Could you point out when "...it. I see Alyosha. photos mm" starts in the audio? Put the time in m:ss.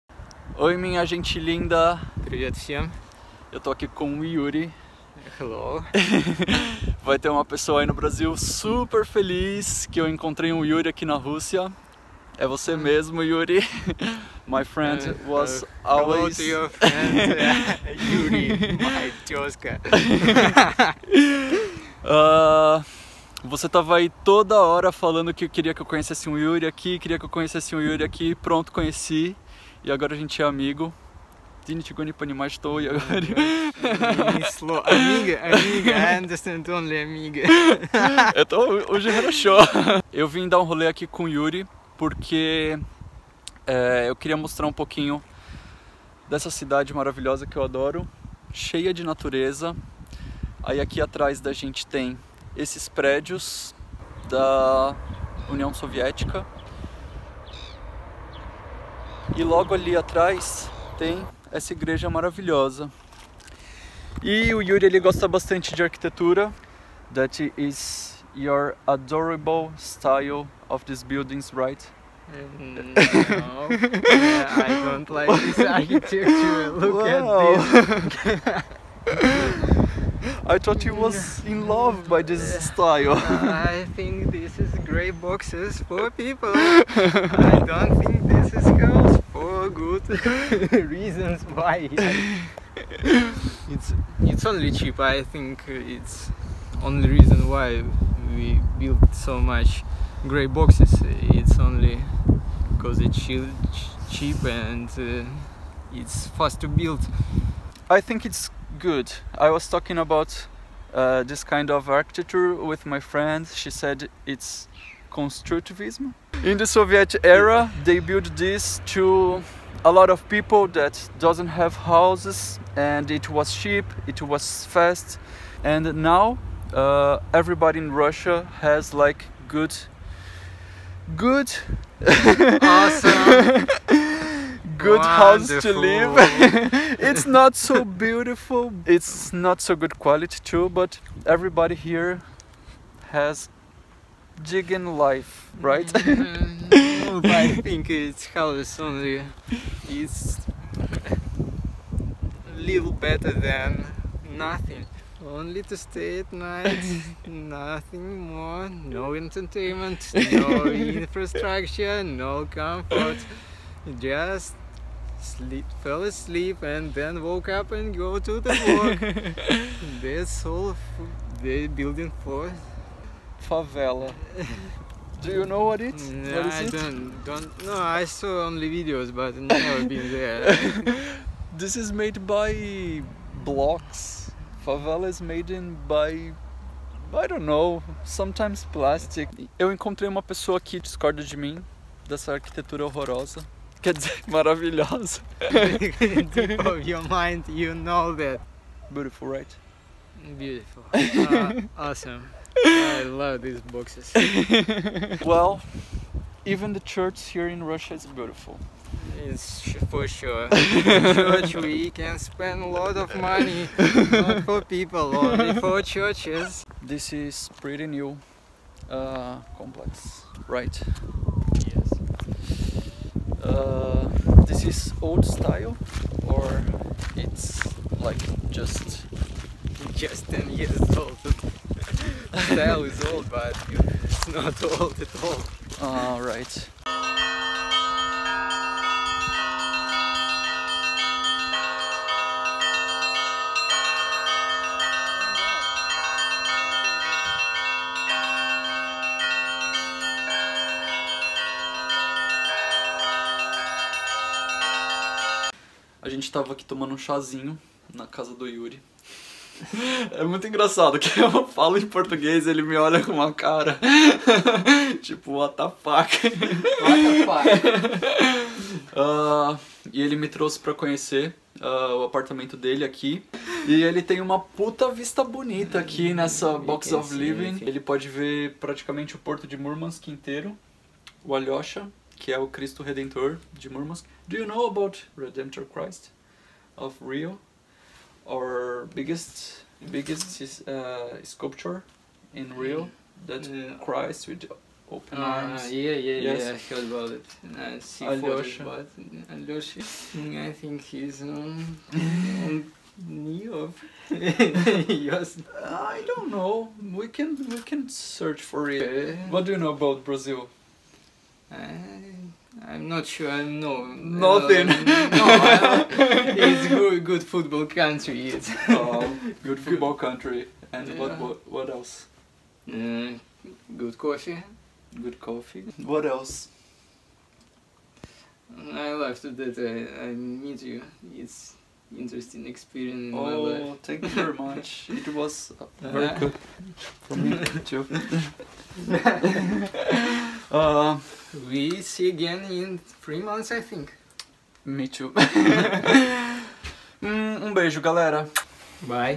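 4:57.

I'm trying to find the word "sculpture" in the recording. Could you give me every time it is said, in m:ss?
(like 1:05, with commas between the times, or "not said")
4:51.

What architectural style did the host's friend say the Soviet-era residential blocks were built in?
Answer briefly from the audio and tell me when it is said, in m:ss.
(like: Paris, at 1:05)
Constructivism, at 1:55.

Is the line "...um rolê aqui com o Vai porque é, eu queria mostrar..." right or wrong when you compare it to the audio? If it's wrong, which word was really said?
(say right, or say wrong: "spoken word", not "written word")
wrong: "Yuri", not "Vai".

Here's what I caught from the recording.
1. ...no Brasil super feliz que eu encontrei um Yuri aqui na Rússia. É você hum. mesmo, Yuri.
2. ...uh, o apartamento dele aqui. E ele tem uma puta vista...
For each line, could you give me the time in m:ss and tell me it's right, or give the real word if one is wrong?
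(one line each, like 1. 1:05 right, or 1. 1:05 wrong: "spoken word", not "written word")
1. 0:07 right
2. 4:31 right.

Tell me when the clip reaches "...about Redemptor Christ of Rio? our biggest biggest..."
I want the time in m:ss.
4:44.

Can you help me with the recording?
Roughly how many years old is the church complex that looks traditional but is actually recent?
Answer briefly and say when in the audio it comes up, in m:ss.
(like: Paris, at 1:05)
10, at 3:50.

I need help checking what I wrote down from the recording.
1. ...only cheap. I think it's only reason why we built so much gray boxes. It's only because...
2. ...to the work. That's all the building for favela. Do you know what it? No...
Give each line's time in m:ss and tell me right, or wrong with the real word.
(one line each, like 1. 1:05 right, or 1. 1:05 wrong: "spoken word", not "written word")
1. 1:34 right
2. 2:48 right.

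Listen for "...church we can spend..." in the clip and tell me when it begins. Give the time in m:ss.
3:30.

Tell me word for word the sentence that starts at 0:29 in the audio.
E agora a gente é amigo.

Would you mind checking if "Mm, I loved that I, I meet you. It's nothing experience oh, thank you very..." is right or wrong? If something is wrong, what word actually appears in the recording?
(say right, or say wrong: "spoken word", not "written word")
wrong: "interesting", not "nothing".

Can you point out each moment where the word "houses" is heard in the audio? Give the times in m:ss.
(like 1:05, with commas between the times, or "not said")
2:01, 2:15.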